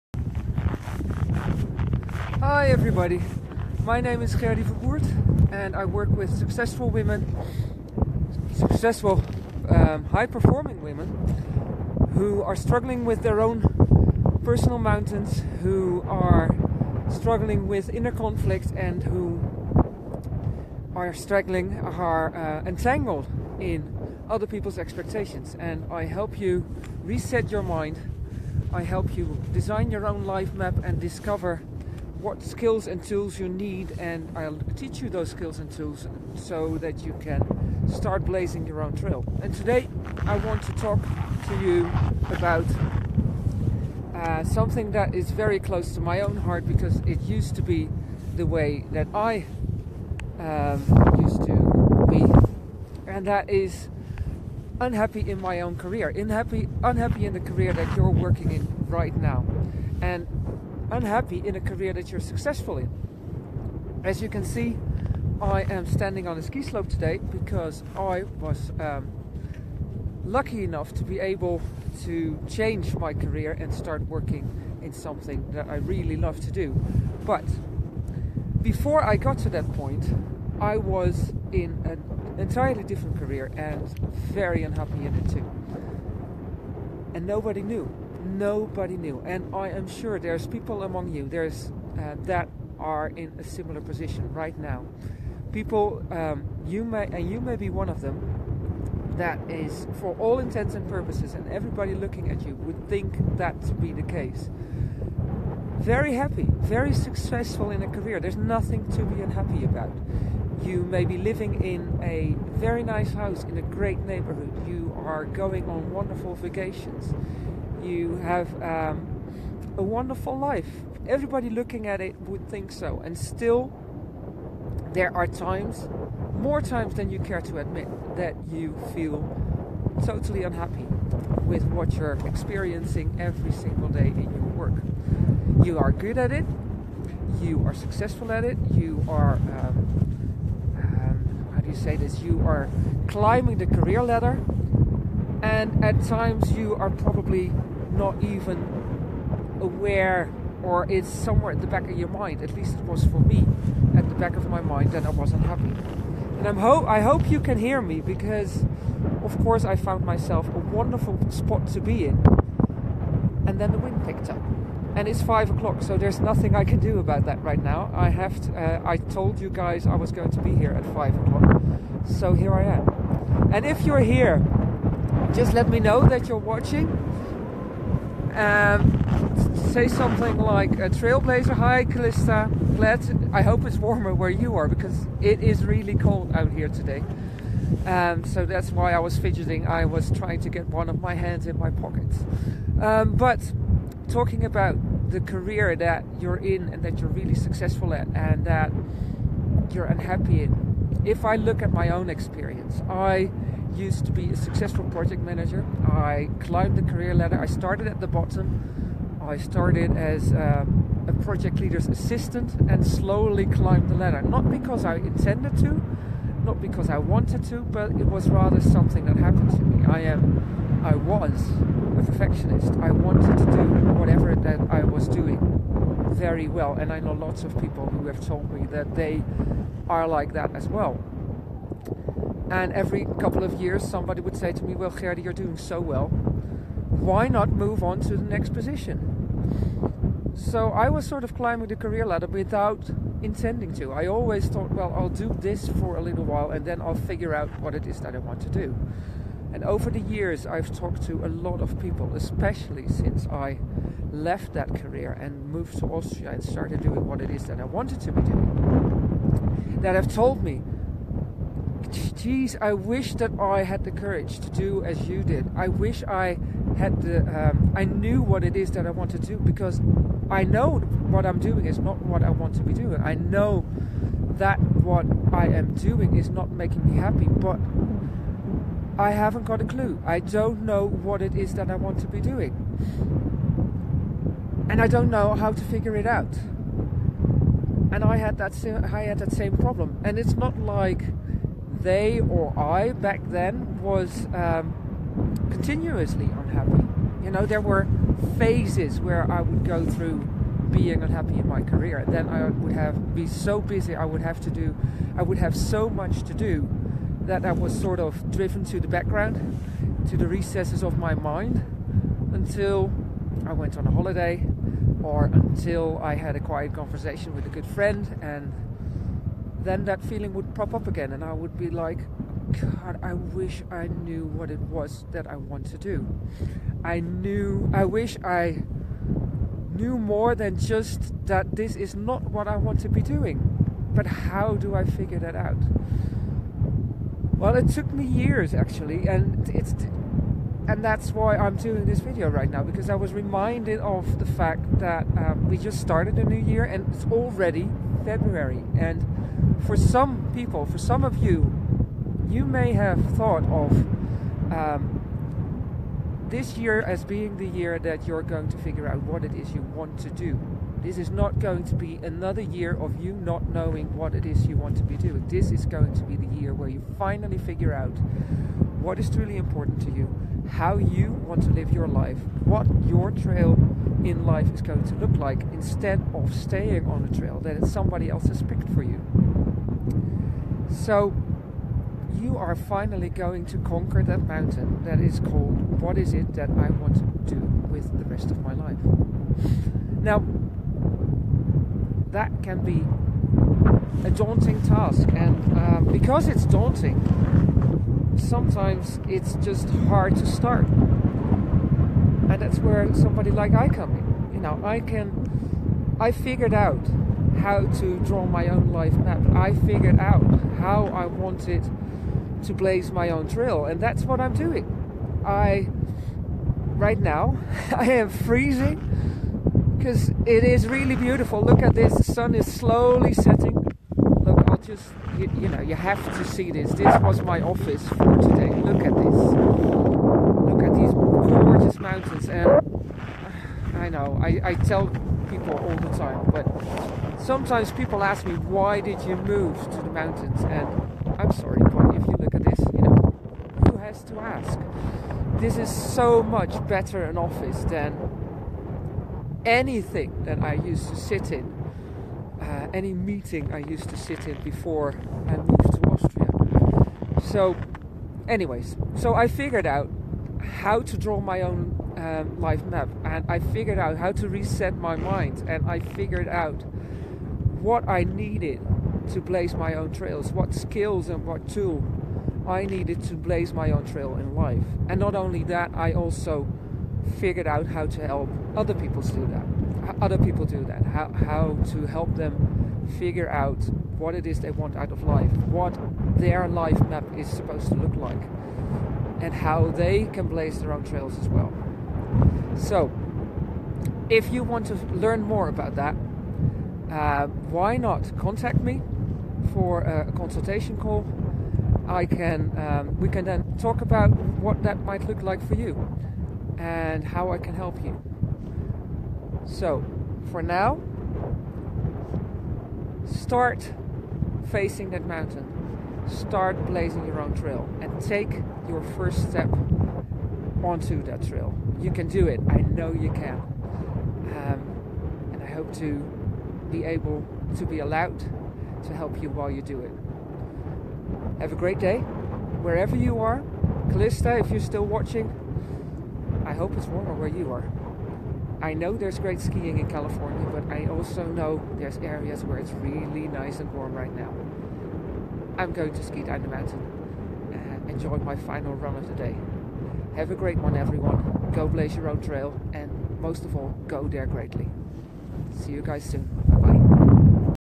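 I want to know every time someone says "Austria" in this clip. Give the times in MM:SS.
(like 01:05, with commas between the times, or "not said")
04:15, 07:35.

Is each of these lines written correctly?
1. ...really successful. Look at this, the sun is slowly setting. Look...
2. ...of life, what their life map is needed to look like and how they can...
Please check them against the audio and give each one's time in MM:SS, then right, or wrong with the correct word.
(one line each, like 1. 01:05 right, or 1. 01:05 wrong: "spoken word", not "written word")
1. 07:00 wrong: "beautiful", not "successful"
2. 08:04 wrong: "supposed", not "needed".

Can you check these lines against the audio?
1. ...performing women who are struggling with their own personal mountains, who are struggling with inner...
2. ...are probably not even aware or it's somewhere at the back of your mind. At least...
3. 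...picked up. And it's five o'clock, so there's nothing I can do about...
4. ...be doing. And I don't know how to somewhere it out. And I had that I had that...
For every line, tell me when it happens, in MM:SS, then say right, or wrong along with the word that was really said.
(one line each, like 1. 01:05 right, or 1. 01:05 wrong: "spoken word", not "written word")
1. 00:10 right
2. 02:26 right
3. 02:44 right
4. 04:42 wrong: "figure", not "somewhere".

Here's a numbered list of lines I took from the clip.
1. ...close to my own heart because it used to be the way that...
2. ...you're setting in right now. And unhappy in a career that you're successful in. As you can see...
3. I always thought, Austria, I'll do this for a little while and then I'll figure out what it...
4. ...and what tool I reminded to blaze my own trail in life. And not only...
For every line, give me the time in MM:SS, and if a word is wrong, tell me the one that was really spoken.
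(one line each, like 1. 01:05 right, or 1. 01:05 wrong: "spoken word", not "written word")
1. 00:45 right
2. 00:57 wrong: "working", not "setting"
3. 04:03 wrong: "Well", not "Austria"
4. 07:51 wrong: "needed", not "reminded".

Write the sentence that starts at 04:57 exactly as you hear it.
You know, there were phases where I would go through being unhappy in my career.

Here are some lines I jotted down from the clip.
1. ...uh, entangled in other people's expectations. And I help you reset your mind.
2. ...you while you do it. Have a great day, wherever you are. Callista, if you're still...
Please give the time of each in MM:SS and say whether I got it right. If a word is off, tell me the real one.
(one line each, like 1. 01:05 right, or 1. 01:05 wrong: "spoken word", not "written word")
1. 00:22 right
2. 08:49 right.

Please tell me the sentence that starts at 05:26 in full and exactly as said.
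I knew, I wish I knew more than just that this is not what I want to be doing.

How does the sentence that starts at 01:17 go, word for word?
But before I got to that point, I was in an entirely different career and very unhappy in it too.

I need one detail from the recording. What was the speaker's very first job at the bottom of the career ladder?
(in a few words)
project leader's assistant.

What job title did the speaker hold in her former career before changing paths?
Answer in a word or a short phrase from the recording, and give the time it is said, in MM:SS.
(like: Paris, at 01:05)
project manager, at 03:24.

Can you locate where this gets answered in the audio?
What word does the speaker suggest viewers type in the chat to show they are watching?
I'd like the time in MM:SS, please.
03:00.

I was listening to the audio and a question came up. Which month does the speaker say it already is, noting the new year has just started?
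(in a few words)
February.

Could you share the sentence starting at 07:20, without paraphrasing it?
And I'm sorry, but if you look at this, you know, who has to ask?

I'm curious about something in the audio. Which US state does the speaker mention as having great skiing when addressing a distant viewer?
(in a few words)
California.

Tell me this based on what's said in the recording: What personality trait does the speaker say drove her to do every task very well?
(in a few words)
perfectionist.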